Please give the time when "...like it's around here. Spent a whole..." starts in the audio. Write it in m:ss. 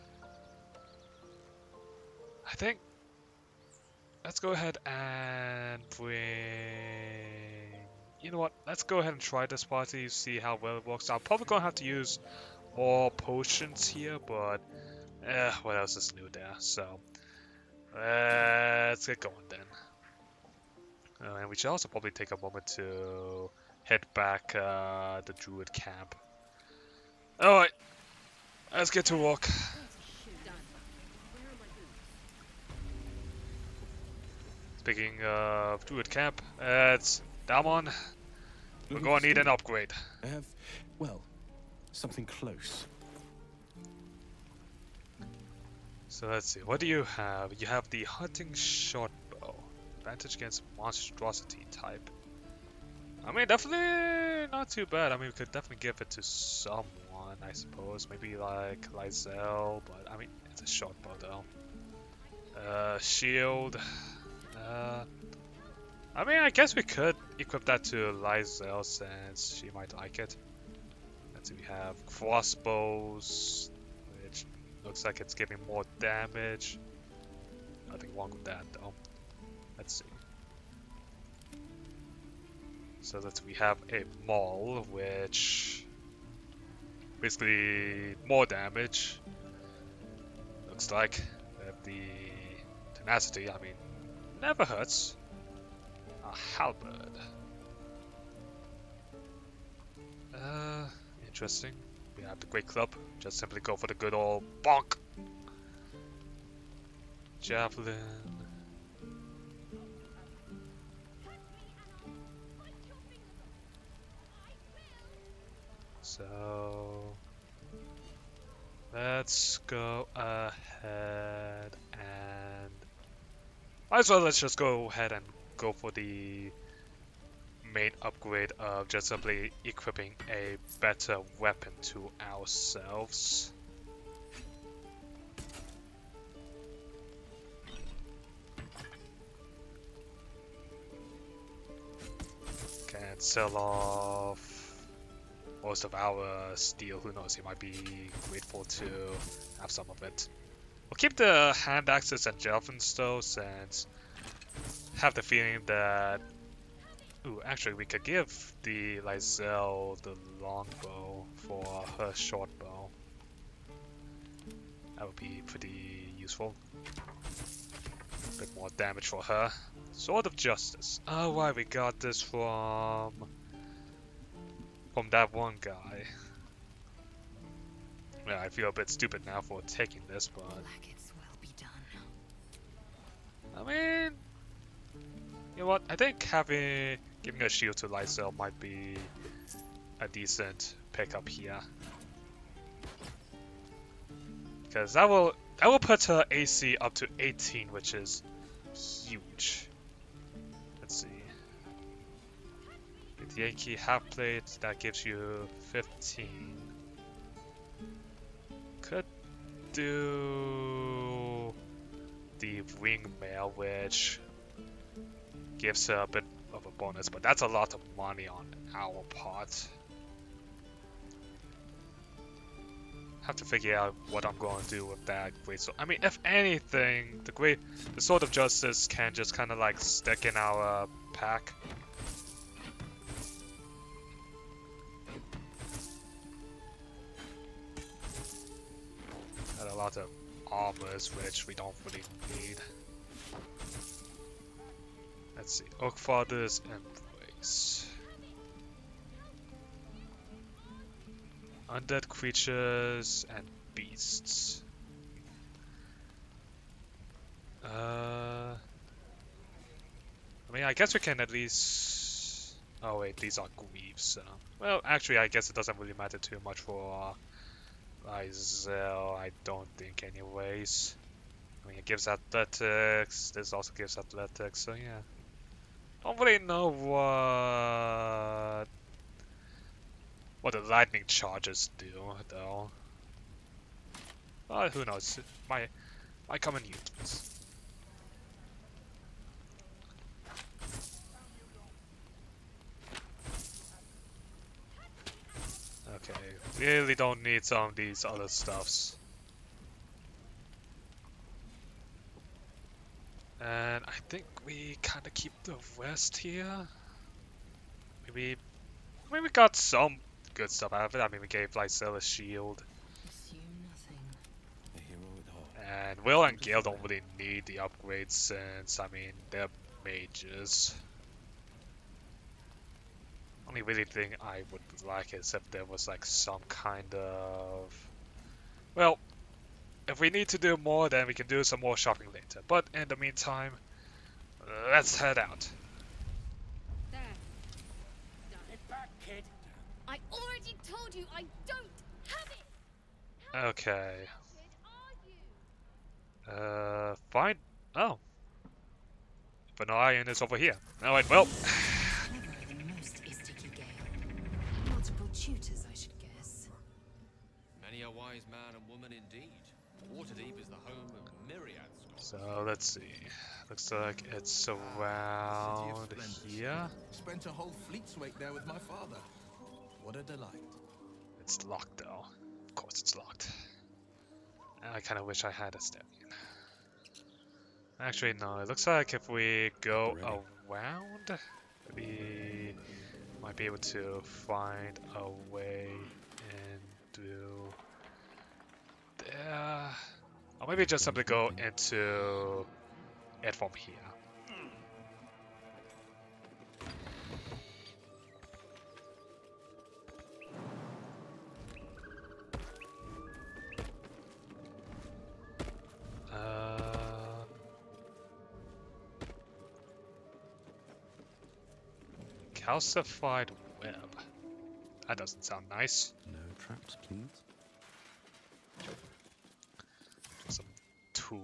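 6:03.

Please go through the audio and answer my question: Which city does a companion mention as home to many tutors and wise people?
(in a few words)
Waterdeep.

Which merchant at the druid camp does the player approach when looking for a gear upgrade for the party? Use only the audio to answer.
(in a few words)
Dammon.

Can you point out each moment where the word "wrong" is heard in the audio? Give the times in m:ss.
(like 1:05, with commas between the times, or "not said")
1:18.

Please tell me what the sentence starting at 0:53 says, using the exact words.
I mean, definitely not too bad.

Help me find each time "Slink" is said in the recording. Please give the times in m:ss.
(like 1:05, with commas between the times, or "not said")
not said.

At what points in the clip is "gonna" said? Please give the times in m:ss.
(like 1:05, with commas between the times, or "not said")
0:38.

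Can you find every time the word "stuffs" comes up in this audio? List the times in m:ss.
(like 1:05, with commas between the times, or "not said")
4:58, 5:10.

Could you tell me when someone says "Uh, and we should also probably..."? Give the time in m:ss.
0:21.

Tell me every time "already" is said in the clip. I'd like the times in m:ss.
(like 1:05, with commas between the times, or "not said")
5:40.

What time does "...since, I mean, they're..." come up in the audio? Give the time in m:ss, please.
5:18.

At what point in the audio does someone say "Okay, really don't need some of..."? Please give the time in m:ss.
4:55.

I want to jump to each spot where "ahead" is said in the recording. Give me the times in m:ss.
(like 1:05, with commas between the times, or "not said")
0:04, 0:08, 2:00, 2:04.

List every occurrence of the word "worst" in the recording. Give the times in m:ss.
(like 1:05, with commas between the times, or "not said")
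not said.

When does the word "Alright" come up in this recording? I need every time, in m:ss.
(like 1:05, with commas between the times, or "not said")
0:27, 5:50.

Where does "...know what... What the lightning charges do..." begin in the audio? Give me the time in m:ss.
4:36.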